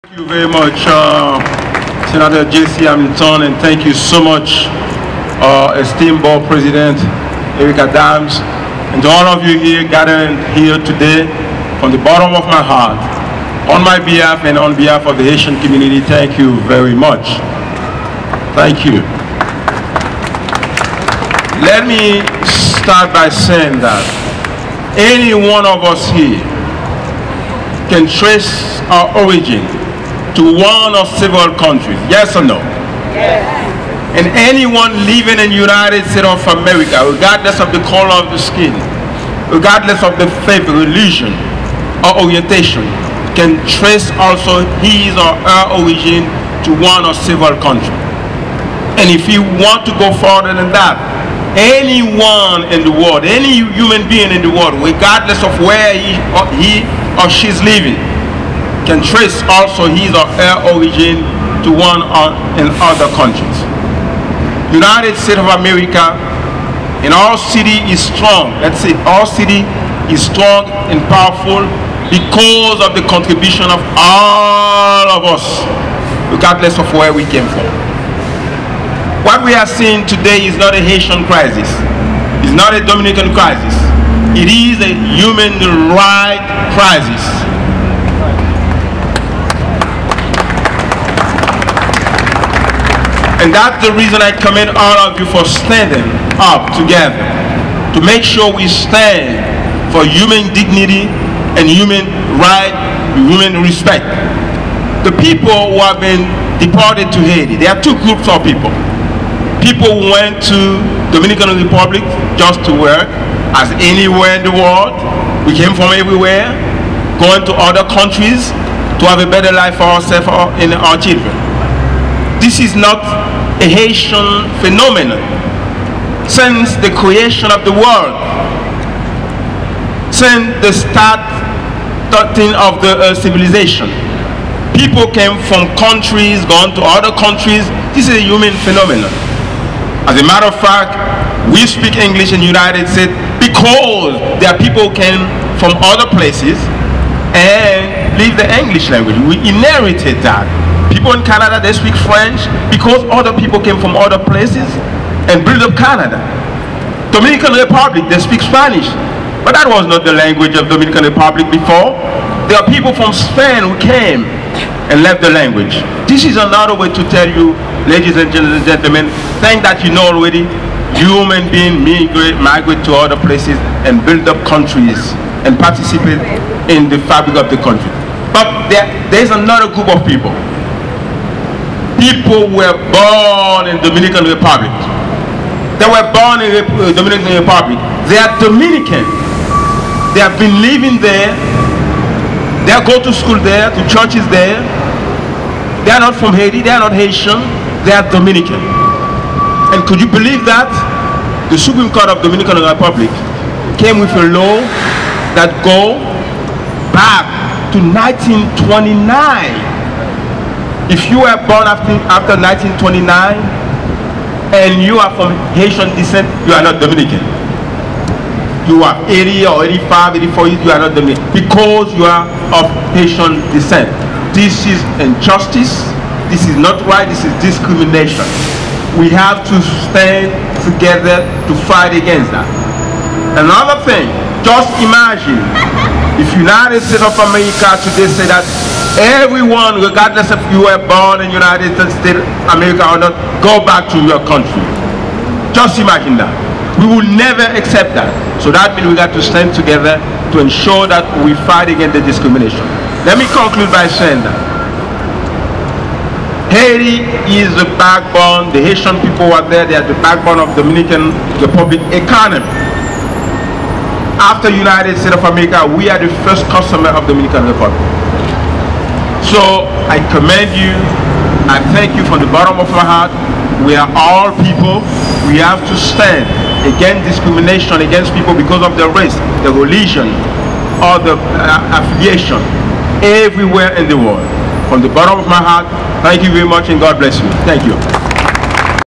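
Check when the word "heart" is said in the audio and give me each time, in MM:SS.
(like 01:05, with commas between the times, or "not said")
00:12, 04:32, 04:45.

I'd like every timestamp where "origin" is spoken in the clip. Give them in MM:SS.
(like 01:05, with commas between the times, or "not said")
00:29, 00:45, 01:00.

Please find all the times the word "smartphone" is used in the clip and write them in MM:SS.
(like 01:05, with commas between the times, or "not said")
not said.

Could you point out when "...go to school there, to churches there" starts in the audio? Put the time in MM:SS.
03:12.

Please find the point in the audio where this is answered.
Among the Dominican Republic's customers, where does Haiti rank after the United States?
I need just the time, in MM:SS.
04:26.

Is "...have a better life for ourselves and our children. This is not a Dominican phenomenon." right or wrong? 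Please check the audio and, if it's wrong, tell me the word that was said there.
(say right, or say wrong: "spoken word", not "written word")
wrong: "Haitian", not "Dominican".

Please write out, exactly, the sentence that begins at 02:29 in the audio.
We inherited that people in Canada, they speak French because other people came from other places and built up Canada.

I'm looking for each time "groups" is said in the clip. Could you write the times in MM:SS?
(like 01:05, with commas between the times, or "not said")
01:48, 02:59.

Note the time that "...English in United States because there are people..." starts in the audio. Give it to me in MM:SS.
02:22.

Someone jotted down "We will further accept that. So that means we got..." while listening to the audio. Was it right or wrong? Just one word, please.
wrong.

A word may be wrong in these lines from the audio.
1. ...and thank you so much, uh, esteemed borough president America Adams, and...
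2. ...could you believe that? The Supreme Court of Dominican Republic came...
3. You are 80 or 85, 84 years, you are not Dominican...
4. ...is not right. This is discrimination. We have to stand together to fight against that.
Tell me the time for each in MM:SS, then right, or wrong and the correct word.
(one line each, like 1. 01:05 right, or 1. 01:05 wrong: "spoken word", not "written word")
1. 00:03 wrong: "Eric", not "America"
2. 03:19 right
3. 03:38 right
4. 03:46 right.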